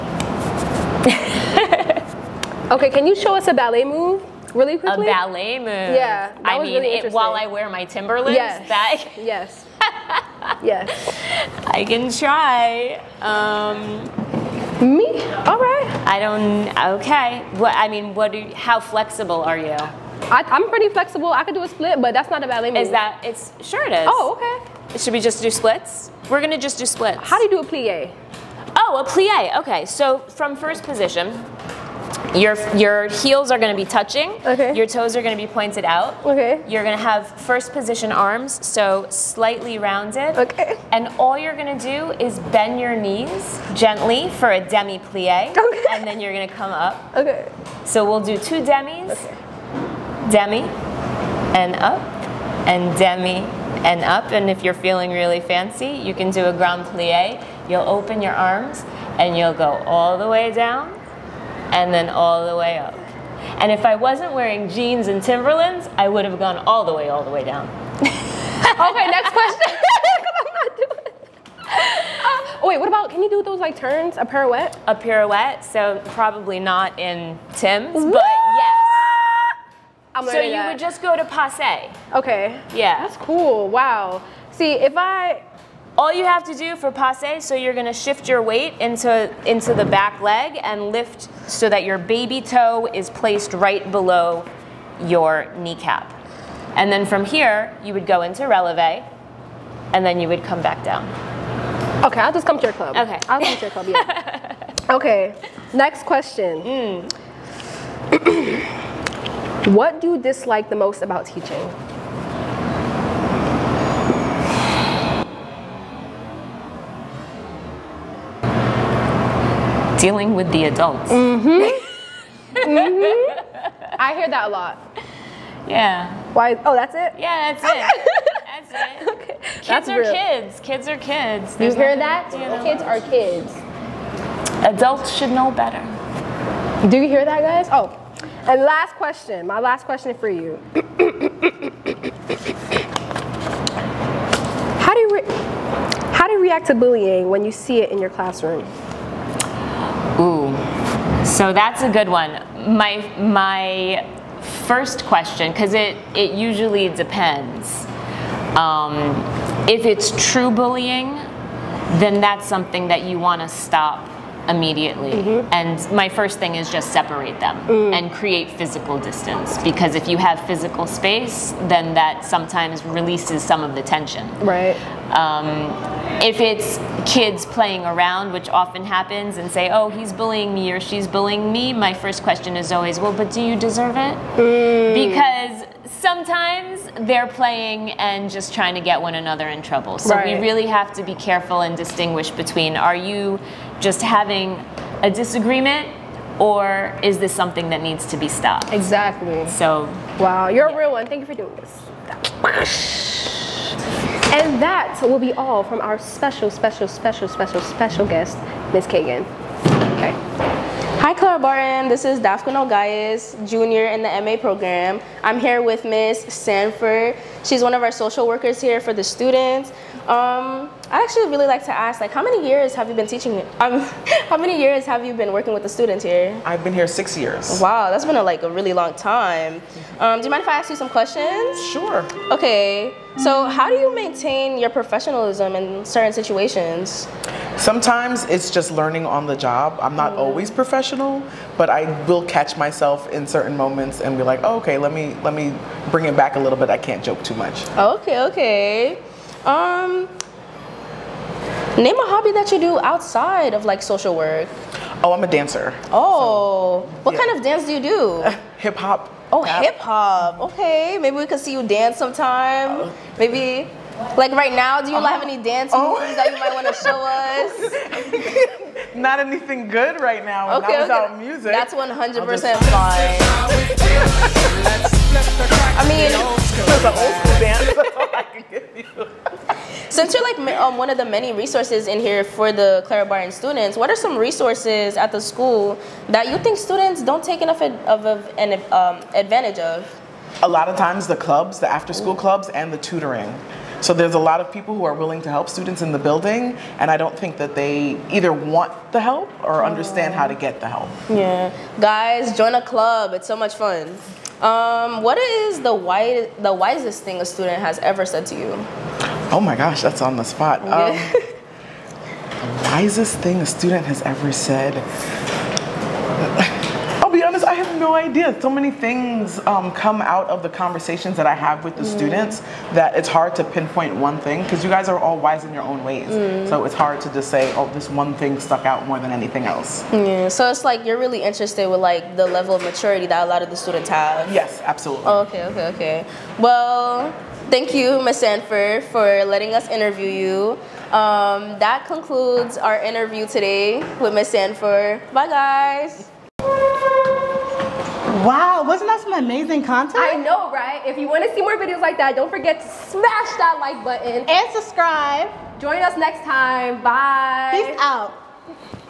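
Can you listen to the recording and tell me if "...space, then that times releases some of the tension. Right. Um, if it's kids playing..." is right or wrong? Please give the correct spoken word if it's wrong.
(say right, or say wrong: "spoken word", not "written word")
wrong: "sometimes", not "times".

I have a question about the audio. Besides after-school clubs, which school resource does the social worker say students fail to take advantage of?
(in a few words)
Tutoring.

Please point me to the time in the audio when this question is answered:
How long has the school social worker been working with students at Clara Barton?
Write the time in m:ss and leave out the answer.
3:46.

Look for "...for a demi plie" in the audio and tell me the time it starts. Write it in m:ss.
0:44.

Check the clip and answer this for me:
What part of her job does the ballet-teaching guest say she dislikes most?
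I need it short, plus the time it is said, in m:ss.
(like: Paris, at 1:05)
Dealing with the adults, at 2:00.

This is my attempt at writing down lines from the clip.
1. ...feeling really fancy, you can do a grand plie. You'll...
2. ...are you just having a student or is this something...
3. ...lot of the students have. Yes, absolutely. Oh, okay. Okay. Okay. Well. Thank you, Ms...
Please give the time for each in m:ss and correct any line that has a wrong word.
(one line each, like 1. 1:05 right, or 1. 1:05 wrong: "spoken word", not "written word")
1. 0:54 right
2. 3:12 wrong: "disagreement", not "student"
3. 5:33 right.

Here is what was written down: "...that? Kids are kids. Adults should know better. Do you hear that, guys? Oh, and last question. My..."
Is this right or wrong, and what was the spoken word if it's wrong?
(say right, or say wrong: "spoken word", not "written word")
right.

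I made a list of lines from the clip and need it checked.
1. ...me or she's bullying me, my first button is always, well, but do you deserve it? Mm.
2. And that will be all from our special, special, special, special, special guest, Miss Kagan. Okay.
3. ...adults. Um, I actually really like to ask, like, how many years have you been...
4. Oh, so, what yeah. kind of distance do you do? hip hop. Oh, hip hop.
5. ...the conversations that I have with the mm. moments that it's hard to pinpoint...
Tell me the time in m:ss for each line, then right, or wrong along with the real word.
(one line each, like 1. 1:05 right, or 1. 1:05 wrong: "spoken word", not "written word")
1. 3:00 wrong: "question", not "button"
2. 3:24 right
3. 3:39 wrong: "students", not "adults"
4. 4:15 wrong: "dance", not "distance"
5. 5:20 wrong: "students", not "moments".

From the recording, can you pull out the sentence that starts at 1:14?
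A pirouette, so probably not in Tim's, but yes.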